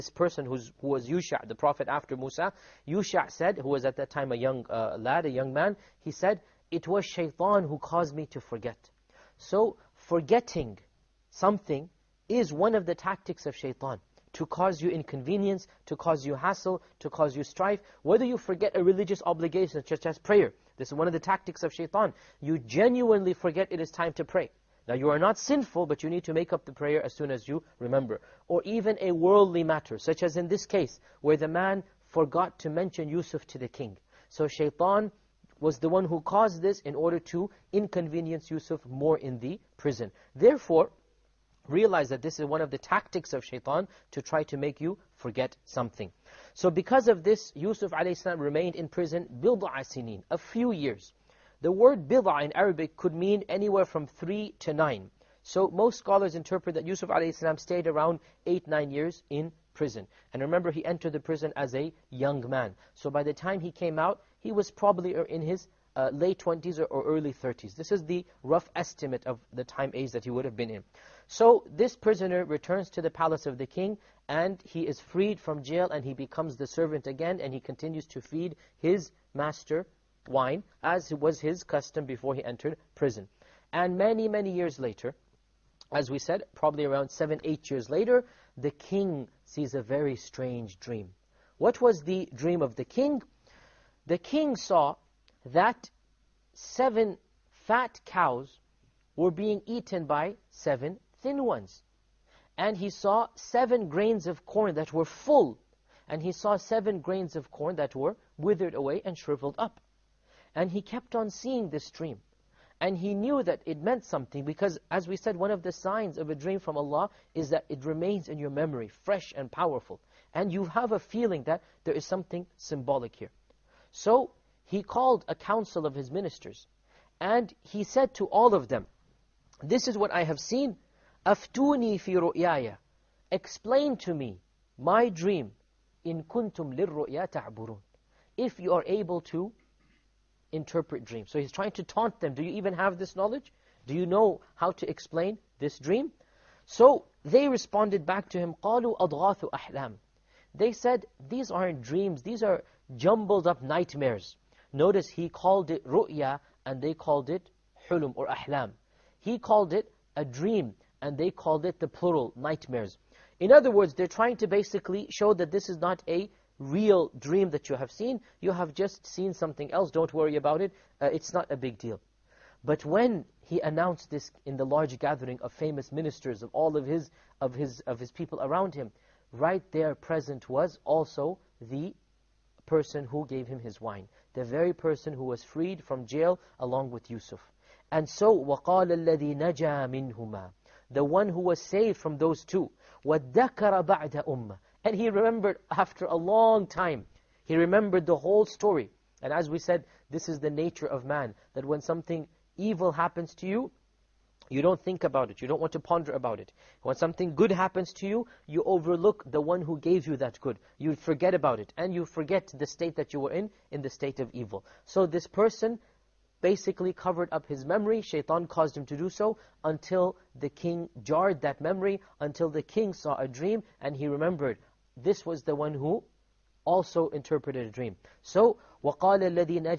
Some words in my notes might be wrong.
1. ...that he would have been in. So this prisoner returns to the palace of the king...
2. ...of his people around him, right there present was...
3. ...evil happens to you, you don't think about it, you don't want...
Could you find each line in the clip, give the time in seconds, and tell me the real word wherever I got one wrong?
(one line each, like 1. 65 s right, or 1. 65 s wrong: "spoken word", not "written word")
1. 70 s right
2. 177 s right
3. 202 s right.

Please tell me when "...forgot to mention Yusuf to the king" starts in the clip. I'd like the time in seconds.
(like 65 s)
32 s.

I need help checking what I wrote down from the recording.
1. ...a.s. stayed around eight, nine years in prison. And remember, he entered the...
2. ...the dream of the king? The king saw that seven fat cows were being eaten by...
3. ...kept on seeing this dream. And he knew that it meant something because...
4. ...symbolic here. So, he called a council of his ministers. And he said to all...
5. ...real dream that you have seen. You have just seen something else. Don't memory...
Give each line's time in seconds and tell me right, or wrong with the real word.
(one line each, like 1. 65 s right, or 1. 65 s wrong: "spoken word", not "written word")
1. 57 s right
2. 92 s right
3. 110 s right
4. 122 s right
5. 166 s wrong: "worry", not "memory".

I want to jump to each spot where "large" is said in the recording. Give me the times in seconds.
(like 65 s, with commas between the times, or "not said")
174 s.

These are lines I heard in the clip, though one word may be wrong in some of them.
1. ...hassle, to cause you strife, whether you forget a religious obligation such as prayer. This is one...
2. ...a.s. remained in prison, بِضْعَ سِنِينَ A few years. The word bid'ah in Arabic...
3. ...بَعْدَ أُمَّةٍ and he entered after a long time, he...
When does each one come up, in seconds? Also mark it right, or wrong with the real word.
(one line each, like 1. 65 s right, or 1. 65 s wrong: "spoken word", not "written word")
1. 16 s right
2. 47 s right
3. 193 s wrong: "remembered", not "entered".